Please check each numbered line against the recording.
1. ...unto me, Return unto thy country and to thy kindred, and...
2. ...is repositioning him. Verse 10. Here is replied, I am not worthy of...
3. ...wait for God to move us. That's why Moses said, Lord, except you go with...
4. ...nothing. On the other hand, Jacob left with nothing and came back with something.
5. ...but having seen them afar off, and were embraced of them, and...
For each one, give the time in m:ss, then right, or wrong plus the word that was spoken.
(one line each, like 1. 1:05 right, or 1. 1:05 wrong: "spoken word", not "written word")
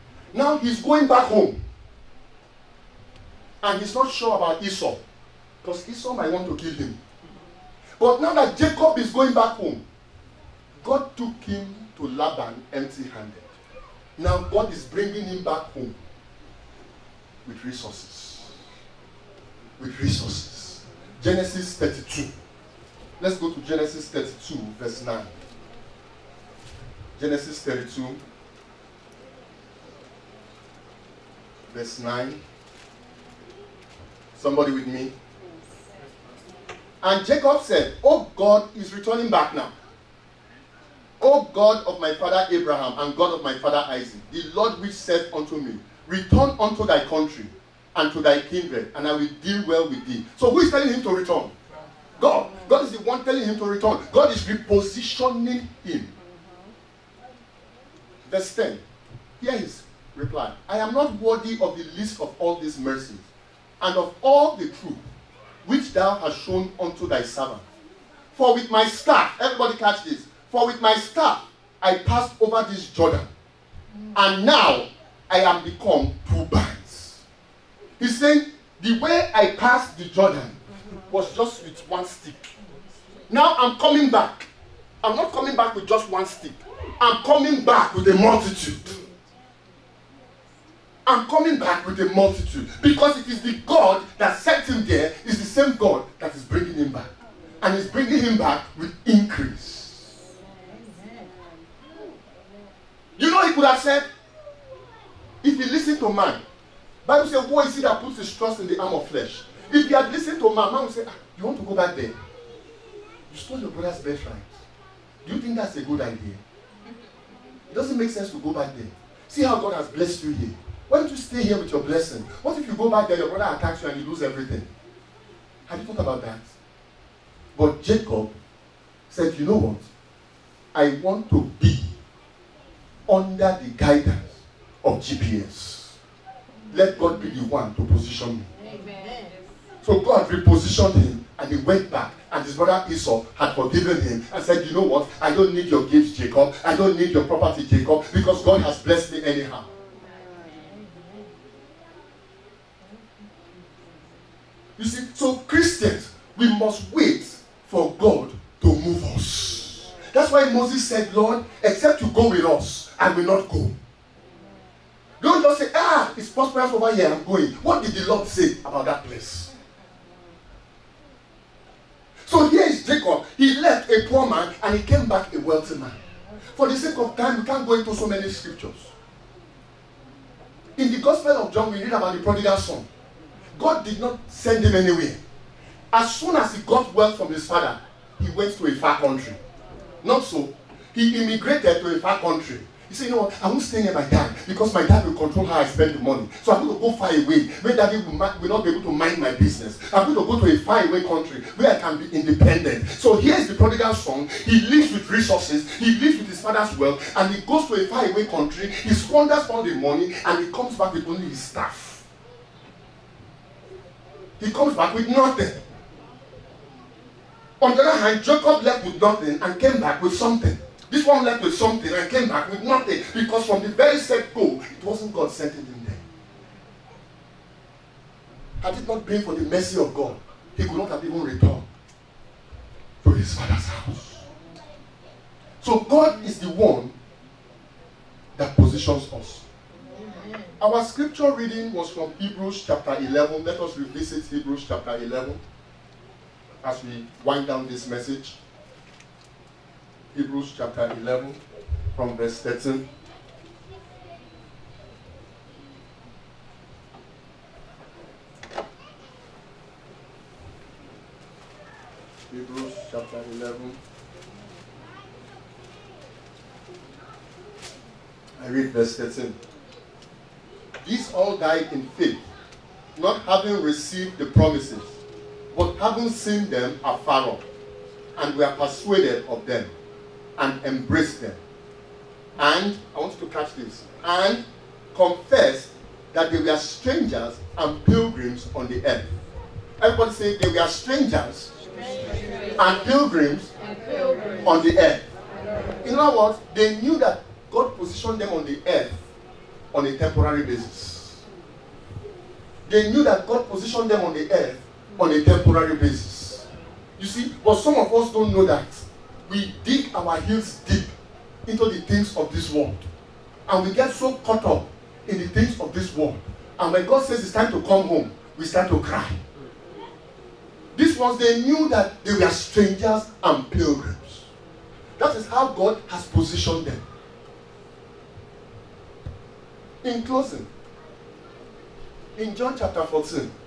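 1. 0:45 right
2. 0:54 right
3. 2:36 right
4. 3:35 right
5. 4:35 wrong: "persuaded", not "embraced".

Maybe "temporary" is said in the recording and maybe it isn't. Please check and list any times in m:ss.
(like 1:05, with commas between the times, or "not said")
4:59, 5:05.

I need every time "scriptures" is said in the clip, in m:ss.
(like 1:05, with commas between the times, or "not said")
2:58, 4:00.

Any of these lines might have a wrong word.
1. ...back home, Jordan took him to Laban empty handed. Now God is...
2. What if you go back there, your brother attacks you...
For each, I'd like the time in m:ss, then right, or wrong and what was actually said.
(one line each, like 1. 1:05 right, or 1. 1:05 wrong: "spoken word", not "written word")
1. 0:09 wrong: "God", not "Jordan"
2. 2:02 right.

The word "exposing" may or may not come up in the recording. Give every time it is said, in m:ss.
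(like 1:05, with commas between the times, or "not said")
not said.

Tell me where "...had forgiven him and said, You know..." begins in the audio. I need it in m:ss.
2:23.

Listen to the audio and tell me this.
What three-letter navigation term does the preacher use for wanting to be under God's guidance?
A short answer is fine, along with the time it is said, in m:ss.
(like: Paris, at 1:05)
GPS, at 2:14.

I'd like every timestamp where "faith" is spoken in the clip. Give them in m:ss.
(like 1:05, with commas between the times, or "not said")
4:31.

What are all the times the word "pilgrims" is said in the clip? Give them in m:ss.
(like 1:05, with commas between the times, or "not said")
4:47, 4:52, 5:23.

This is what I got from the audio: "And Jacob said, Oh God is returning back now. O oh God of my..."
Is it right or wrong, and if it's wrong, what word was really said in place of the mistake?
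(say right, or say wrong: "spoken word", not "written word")
right.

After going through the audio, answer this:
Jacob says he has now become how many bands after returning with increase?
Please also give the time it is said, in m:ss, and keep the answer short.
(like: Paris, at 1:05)
2, at 1:16.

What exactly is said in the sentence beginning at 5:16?
And when God says it's time to come home, we start to cry.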